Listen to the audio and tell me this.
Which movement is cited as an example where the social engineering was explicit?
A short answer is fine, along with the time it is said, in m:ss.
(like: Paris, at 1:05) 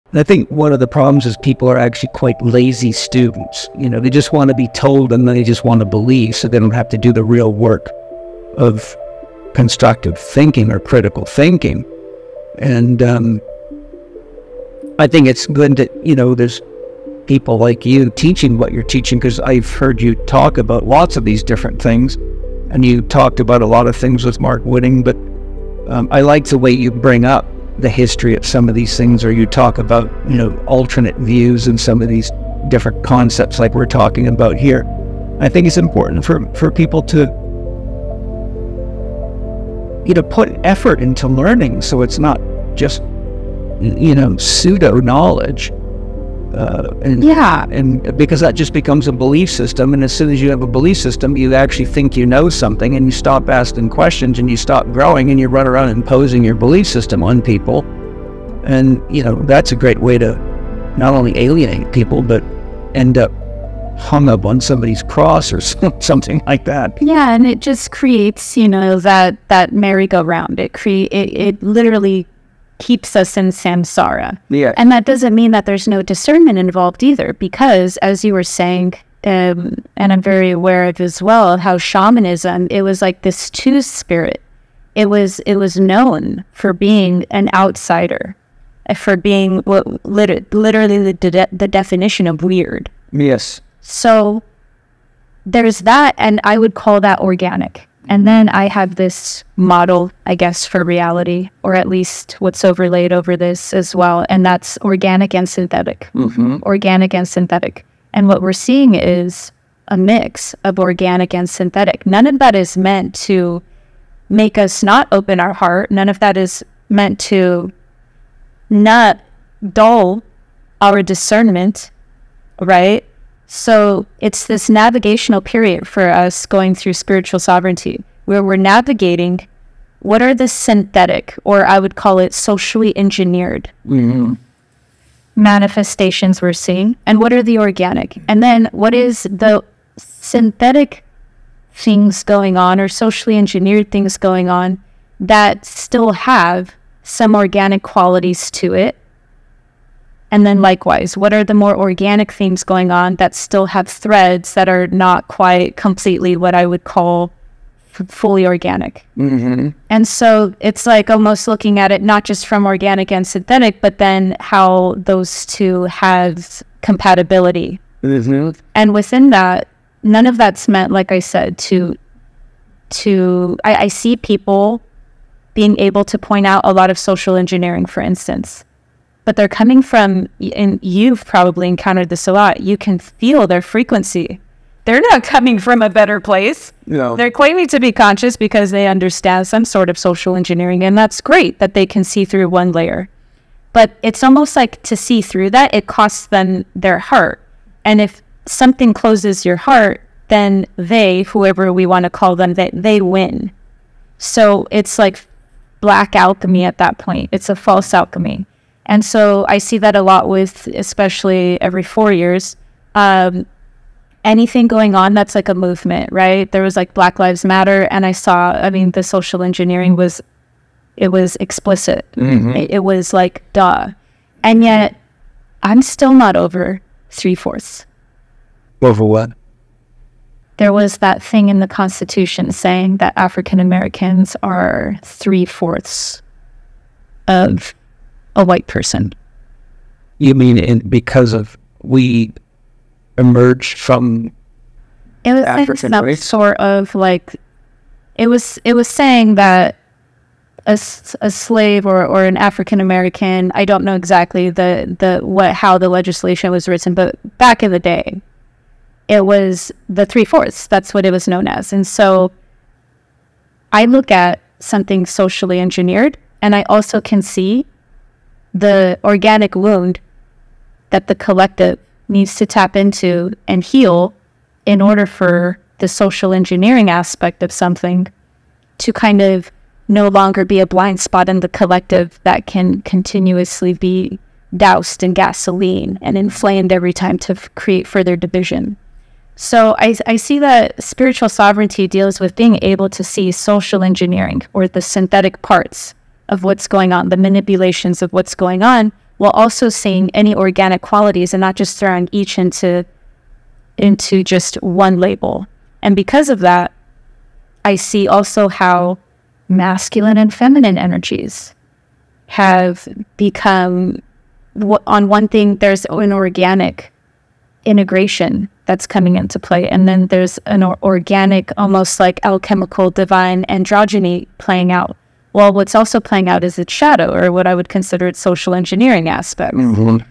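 Black Lives Matter, at 3:36.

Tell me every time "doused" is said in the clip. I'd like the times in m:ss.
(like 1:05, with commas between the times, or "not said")
4:44.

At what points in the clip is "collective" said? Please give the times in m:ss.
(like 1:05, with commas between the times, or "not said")
4:31, 4:41.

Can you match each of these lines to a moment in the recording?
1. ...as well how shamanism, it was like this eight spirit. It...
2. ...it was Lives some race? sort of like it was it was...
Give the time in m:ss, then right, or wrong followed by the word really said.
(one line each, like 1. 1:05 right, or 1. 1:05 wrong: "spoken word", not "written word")
1. 1:20 wrong: "two", not "eight"
2. 4:05 wrong: "African", not "Lives".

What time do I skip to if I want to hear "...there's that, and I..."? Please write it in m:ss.
1:35.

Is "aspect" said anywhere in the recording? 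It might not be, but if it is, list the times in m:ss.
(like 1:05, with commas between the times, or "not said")
4:36, 5:29.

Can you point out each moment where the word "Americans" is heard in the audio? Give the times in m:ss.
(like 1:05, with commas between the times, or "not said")
3:53, 4:12.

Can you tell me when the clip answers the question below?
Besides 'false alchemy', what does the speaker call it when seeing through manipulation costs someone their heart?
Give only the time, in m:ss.
3:25.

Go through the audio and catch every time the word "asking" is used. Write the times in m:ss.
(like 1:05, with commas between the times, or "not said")
0:53.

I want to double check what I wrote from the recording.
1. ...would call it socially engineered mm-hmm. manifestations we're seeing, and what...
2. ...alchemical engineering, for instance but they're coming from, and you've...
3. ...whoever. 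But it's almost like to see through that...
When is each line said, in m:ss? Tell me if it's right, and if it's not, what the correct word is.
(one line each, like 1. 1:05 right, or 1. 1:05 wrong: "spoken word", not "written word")
1. 2:11 right
2. 2:56 wrong: "social", not "alchemical"
3. 3:12 wrong: "layer", not "whoever".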